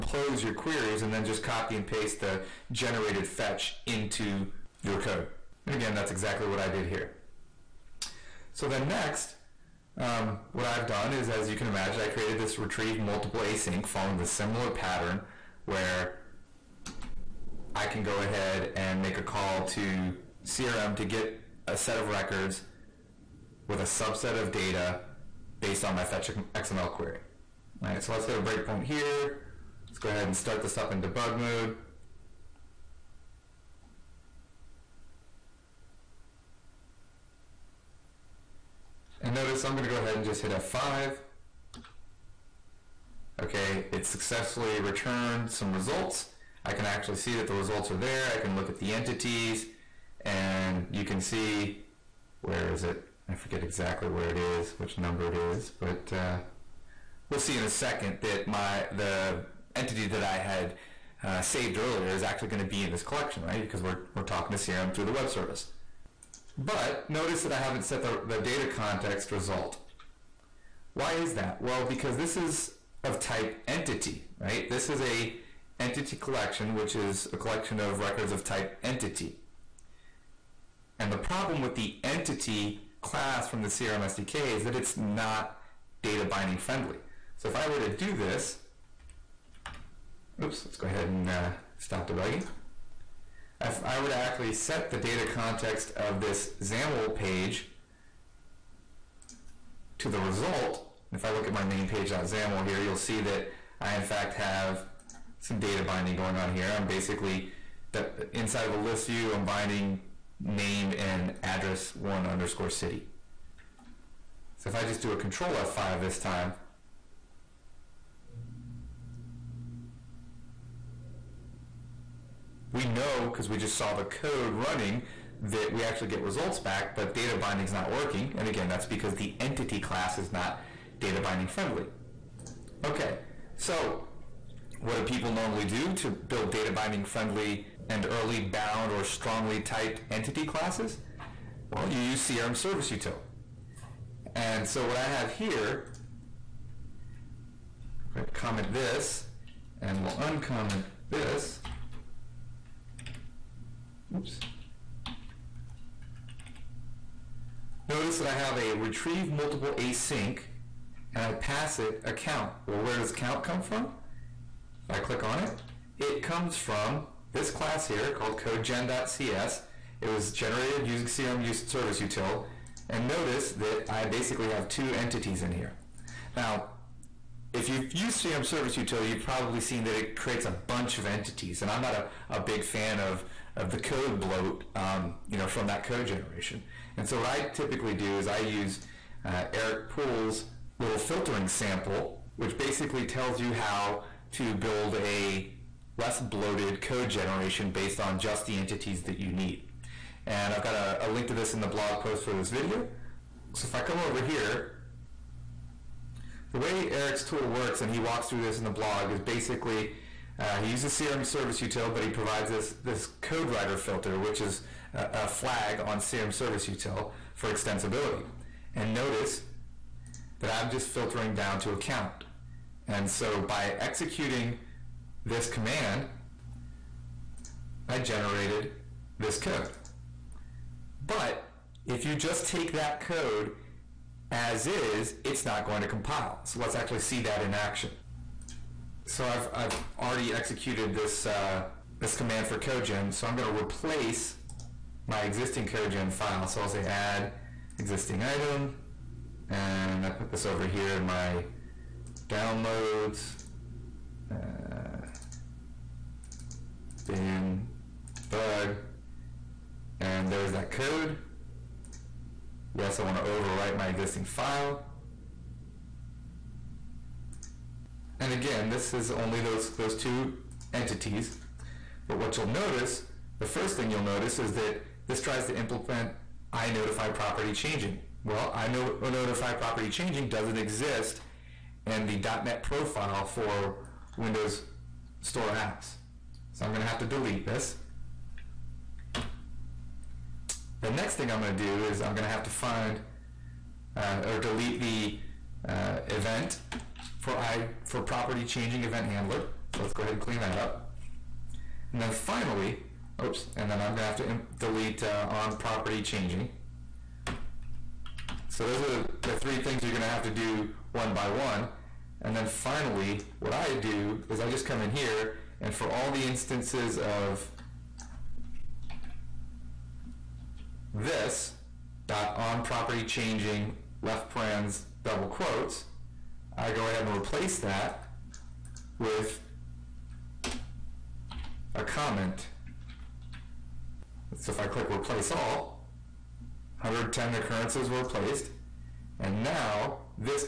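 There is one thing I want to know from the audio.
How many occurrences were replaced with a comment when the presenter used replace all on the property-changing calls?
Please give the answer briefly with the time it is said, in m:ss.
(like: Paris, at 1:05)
110, at 5:36.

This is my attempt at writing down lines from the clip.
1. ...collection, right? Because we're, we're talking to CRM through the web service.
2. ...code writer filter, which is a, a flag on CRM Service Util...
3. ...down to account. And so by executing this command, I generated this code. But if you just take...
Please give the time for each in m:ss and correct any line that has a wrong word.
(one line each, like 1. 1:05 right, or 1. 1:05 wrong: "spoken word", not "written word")
1. 1:03 right
2. 3:33 right
3. 3:41 right.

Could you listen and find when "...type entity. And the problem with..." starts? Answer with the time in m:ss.
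1:18.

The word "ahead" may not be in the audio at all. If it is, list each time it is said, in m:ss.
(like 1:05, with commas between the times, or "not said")
0:18, 0:30, 0:39, 1:30, 5:00, 5:26.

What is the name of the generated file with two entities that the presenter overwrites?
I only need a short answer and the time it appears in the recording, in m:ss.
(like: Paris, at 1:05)
codegen.cs, at 2:48.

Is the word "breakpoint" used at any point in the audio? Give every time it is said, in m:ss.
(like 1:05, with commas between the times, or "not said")
0:28.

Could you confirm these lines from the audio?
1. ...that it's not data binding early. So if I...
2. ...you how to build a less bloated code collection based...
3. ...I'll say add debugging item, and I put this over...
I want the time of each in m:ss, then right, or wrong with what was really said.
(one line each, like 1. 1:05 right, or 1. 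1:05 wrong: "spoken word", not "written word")
1. 1:24 wrong: "friendly", not "early"
2. 3:13 wrong: "generation", not "collection"
3. 4:06 wrong: "existing", not "debugging".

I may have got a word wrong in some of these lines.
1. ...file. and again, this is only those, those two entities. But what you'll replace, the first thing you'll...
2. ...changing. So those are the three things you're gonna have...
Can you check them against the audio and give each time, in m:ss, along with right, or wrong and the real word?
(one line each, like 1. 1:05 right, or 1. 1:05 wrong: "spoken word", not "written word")
1. 4:24 wrong: "notice", not "replace"
2. 5:06 right.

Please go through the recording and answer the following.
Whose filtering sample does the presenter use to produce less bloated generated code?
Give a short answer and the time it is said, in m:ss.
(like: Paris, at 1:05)
Erik Pool, at 3:09.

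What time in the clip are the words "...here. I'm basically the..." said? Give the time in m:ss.
1:46.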